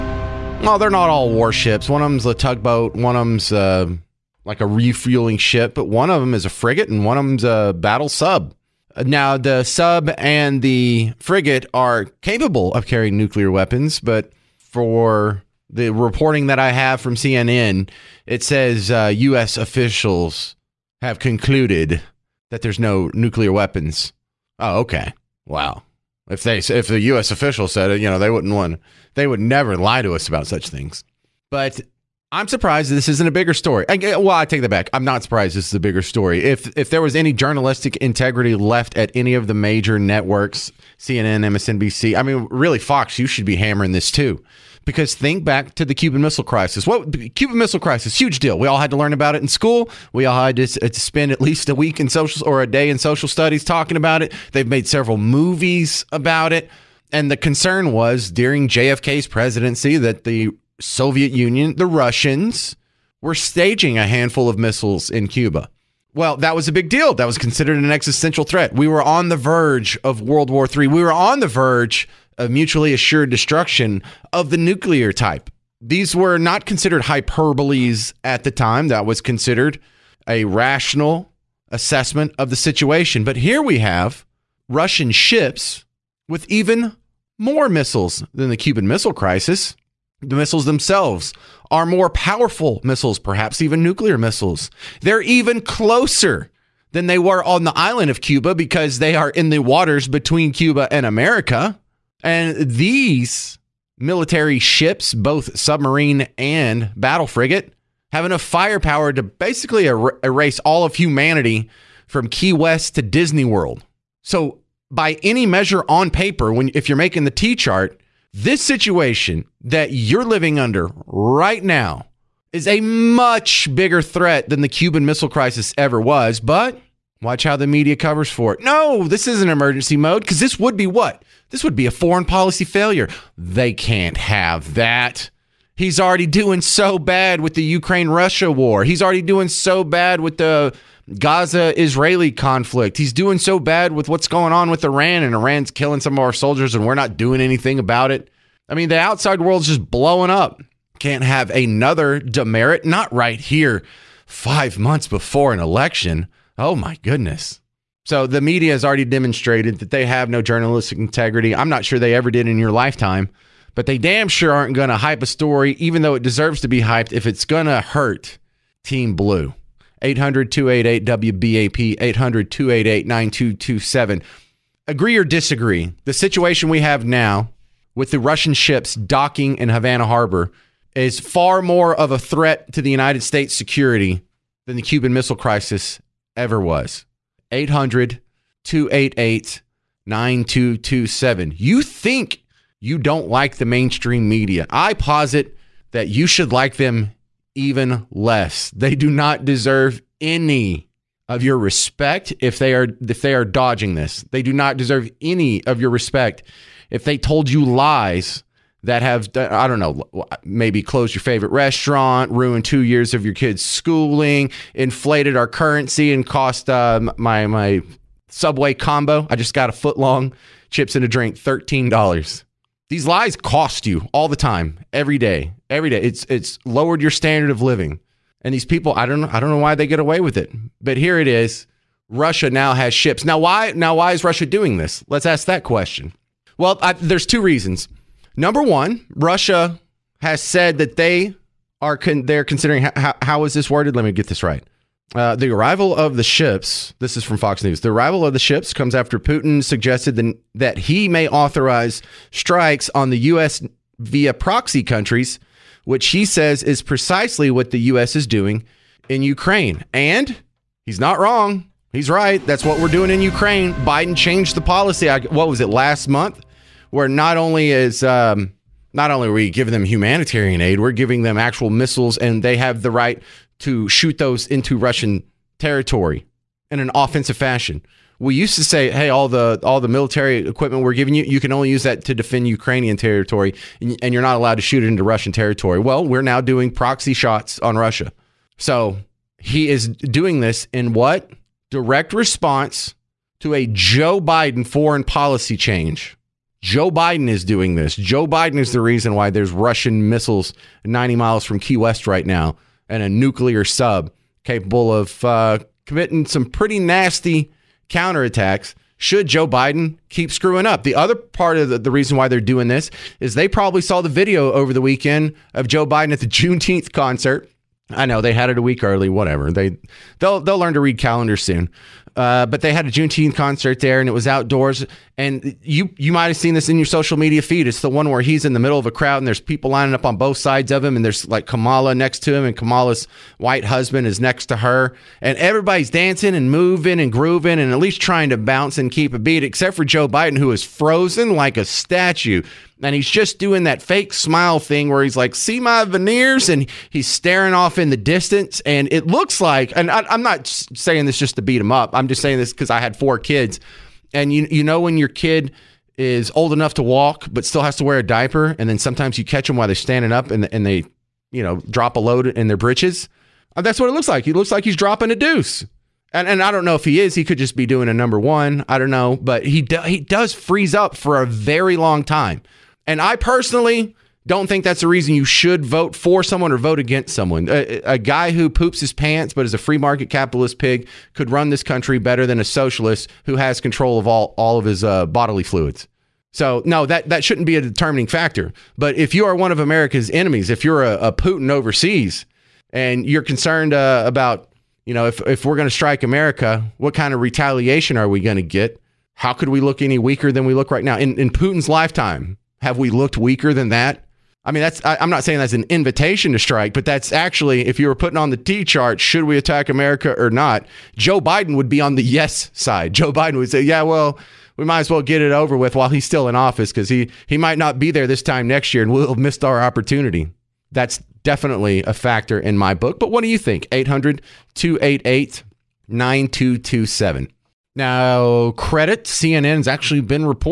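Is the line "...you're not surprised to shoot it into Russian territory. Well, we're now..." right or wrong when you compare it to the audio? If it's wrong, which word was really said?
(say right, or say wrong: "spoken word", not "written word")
wrong: "allowed", not "surprised".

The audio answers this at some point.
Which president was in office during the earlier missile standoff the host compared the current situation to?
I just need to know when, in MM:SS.
00:58.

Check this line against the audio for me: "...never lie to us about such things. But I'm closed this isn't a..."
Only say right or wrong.
wrong.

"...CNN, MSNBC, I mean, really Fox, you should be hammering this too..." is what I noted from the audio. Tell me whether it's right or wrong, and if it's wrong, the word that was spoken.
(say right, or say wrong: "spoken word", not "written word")
right.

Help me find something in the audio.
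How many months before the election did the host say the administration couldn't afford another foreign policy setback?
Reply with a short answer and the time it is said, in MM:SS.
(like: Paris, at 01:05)
5, at 02:34.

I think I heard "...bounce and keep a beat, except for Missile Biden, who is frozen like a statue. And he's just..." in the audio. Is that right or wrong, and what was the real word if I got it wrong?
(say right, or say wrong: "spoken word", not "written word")
wrong: "Joe", not "Missile".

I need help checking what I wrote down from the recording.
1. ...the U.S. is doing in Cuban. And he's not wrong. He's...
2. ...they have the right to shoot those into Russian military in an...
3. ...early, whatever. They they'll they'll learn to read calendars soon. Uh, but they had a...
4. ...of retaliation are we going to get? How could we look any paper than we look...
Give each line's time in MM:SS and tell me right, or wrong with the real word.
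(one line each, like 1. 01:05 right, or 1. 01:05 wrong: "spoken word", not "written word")
1. 04:17 wrong: "Ukraine", not "Cuban"
2. 04:32 wrong: "territory", not "military"
3. 05:18 right
4. 06:37 wrong: "weaker", not "paper".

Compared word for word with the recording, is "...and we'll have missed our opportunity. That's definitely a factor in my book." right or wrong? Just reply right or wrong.
right.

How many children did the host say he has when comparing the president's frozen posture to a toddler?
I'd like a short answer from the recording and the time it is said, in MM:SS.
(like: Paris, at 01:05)
4, at 05:52.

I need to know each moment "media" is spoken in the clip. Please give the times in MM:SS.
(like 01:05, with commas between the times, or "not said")
02:07, 02:38, 03:14, 05:27.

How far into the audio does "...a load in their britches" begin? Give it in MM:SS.
06:01.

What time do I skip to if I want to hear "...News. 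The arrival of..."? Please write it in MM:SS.
04:07.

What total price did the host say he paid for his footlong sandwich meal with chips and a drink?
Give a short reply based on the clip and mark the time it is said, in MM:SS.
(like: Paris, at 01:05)
$13, at 03:41.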